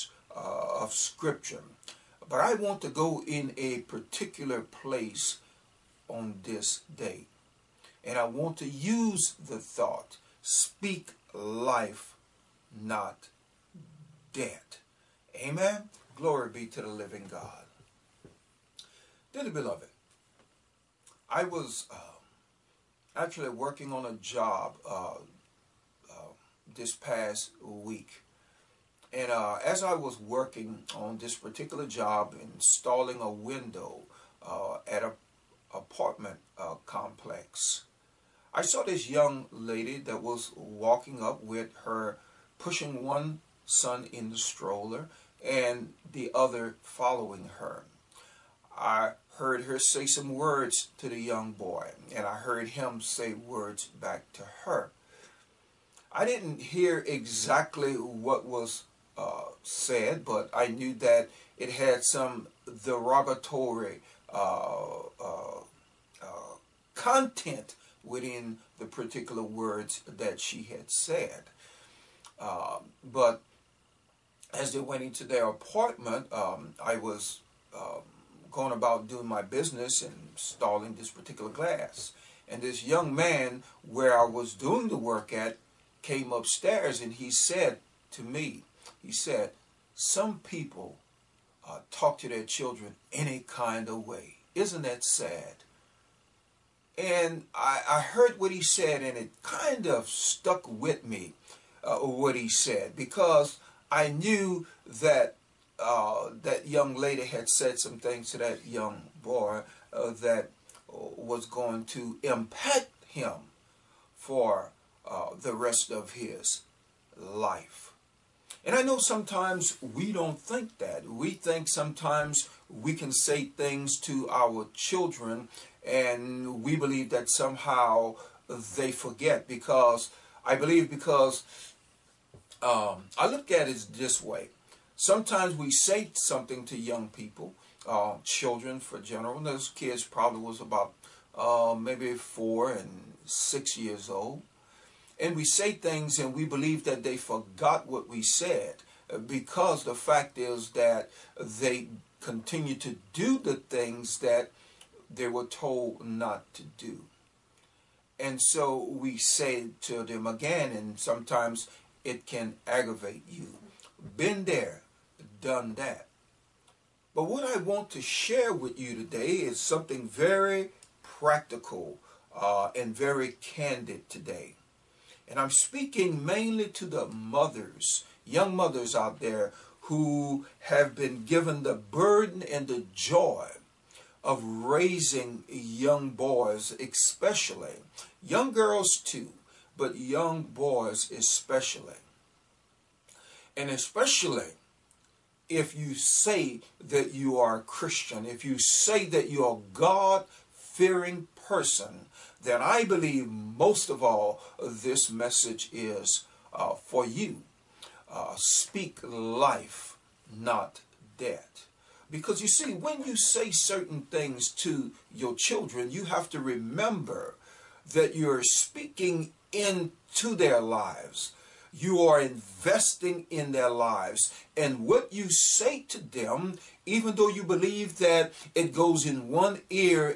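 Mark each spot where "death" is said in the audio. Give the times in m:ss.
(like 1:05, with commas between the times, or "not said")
0:14, 3:31.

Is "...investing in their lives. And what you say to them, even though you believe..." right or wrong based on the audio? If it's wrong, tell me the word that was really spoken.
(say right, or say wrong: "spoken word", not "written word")
right.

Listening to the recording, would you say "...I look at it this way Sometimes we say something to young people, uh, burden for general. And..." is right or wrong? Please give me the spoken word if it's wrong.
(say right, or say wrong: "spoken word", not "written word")
wrong: "children", not "burden".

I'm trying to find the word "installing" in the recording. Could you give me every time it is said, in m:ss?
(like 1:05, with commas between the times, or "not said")
0:32, 1:20.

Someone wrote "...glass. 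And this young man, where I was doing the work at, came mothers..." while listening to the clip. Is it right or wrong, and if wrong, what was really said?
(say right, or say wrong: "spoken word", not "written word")
wrong: "upstairs", not "mothers".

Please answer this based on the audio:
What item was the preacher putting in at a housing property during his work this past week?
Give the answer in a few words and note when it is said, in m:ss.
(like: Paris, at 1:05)
window, at 0:33.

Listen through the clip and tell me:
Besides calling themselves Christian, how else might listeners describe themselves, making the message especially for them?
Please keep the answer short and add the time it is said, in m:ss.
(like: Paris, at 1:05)
God fearing person, at 3:19.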